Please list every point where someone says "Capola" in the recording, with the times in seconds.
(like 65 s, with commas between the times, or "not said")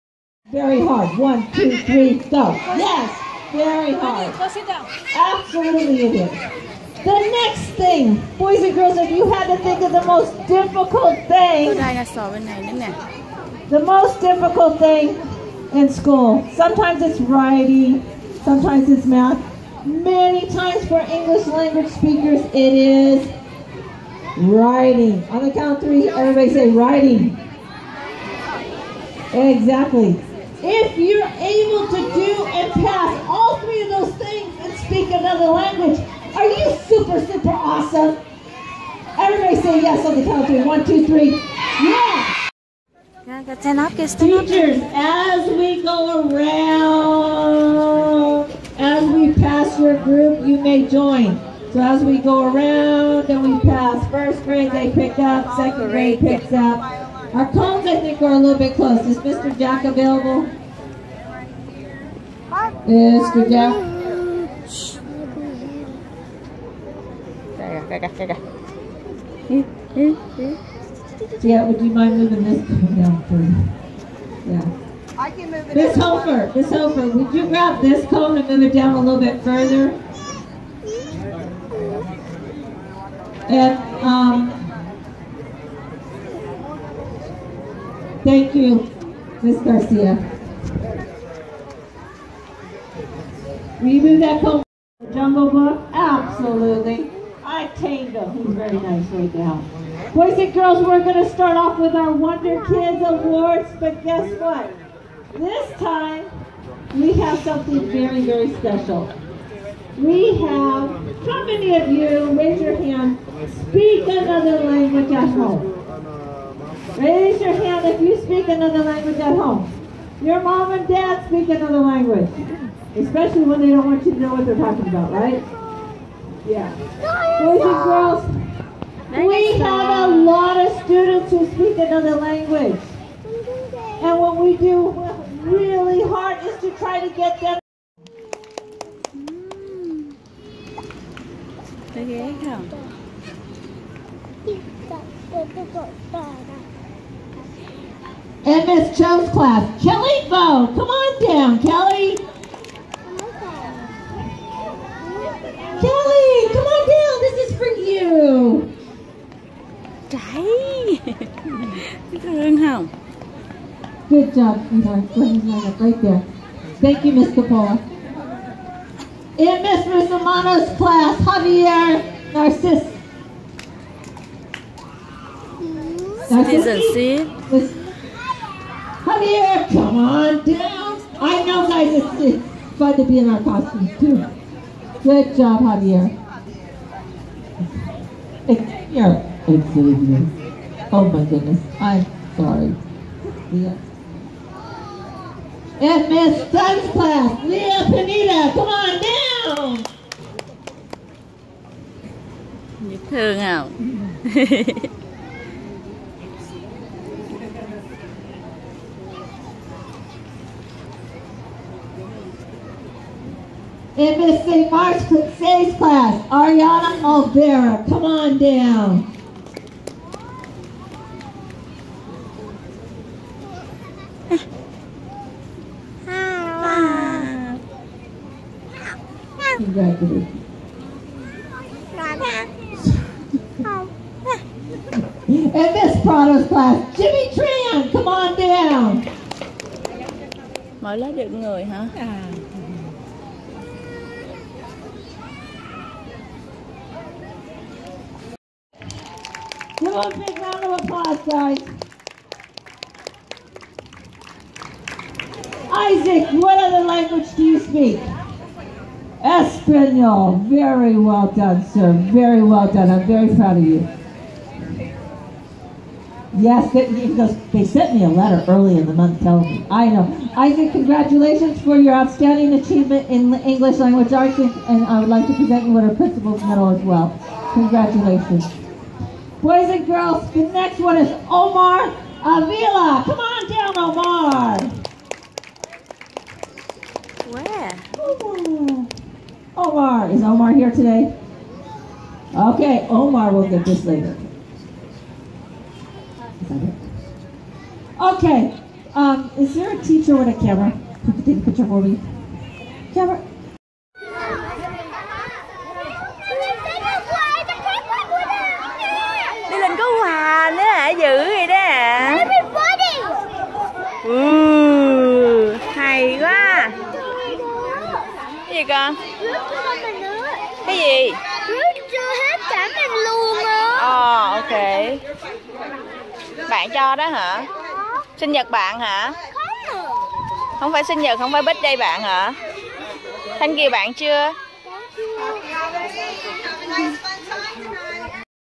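167 s.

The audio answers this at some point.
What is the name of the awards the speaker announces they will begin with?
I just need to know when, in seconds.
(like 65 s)
102 s.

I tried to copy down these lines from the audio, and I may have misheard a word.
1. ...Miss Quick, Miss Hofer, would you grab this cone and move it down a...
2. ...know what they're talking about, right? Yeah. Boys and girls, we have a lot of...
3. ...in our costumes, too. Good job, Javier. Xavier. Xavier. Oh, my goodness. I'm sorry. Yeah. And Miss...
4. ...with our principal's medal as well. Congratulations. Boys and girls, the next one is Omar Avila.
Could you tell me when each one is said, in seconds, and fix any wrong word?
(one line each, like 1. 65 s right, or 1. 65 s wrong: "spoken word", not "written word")
1. 75 s wrong: "Hofer", not "Quick"
2. 124 s right
3. 183 s right
4. 275 s right.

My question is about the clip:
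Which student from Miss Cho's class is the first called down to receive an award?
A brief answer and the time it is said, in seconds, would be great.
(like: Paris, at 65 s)
Kelly Bo, at 149 s.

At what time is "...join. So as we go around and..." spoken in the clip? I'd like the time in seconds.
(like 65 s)
50 s.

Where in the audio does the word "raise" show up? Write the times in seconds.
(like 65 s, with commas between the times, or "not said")
112 s, 117 s.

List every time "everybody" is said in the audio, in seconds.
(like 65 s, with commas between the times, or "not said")
26 s, 39 s.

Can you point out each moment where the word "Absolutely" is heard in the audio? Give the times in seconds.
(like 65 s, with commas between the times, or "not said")
5 s, 95 s.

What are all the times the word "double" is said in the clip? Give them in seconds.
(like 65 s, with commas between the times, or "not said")
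not said.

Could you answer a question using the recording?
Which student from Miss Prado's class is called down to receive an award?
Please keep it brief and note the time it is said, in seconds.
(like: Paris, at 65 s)
Jimmy Tran, at 236 s.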